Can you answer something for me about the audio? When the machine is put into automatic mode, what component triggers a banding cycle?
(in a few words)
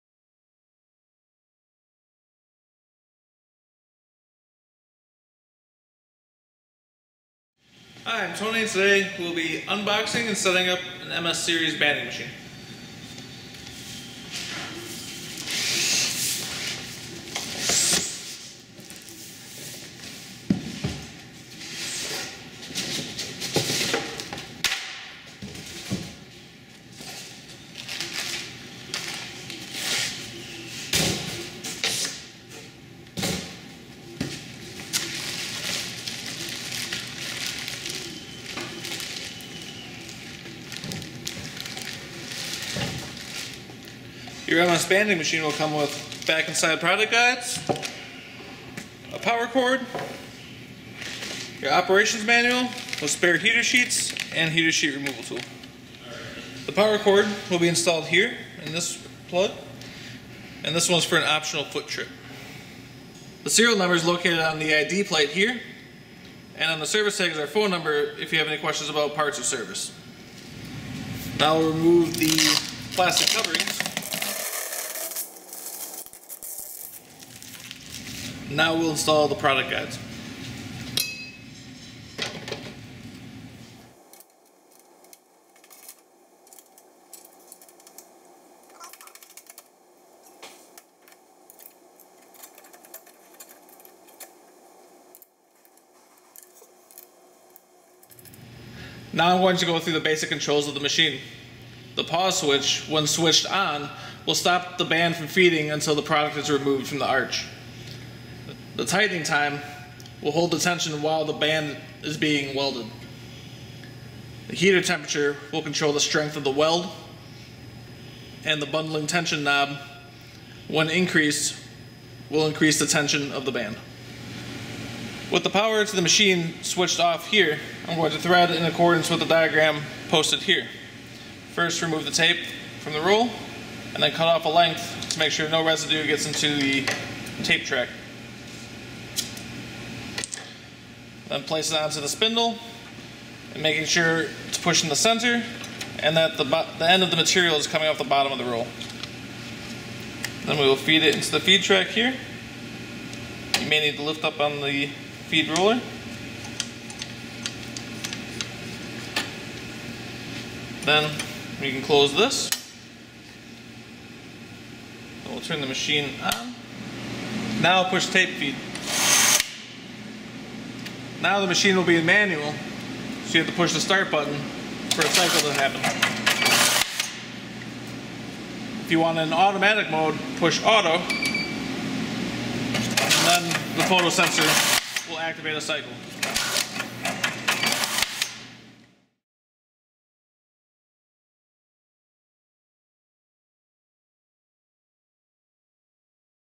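Photo sensor.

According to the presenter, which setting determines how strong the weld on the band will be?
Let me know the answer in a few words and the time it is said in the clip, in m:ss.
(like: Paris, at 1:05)
Heater temperature, at 1:54.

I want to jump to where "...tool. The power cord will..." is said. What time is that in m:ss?
0:55.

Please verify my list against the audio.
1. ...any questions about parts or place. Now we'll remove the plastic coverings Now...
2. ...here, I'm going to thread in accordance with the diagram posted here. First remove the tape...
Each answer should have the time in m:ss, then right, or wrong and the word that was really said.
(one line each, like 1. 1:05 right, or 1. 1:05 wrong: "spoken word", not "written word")
1. 1:08 wrong: "service", not "place"
2. 2:07 right.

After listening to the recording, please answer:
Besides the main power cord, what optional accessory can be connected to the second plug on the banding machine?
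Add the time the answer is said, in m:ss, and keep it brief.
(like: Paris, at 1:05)
Foot trip, at 1:01.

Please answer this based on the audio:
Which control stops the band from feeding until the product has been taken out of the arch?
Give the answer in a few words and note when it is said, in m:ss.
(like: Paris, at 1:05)
Pause switch, at 1:41.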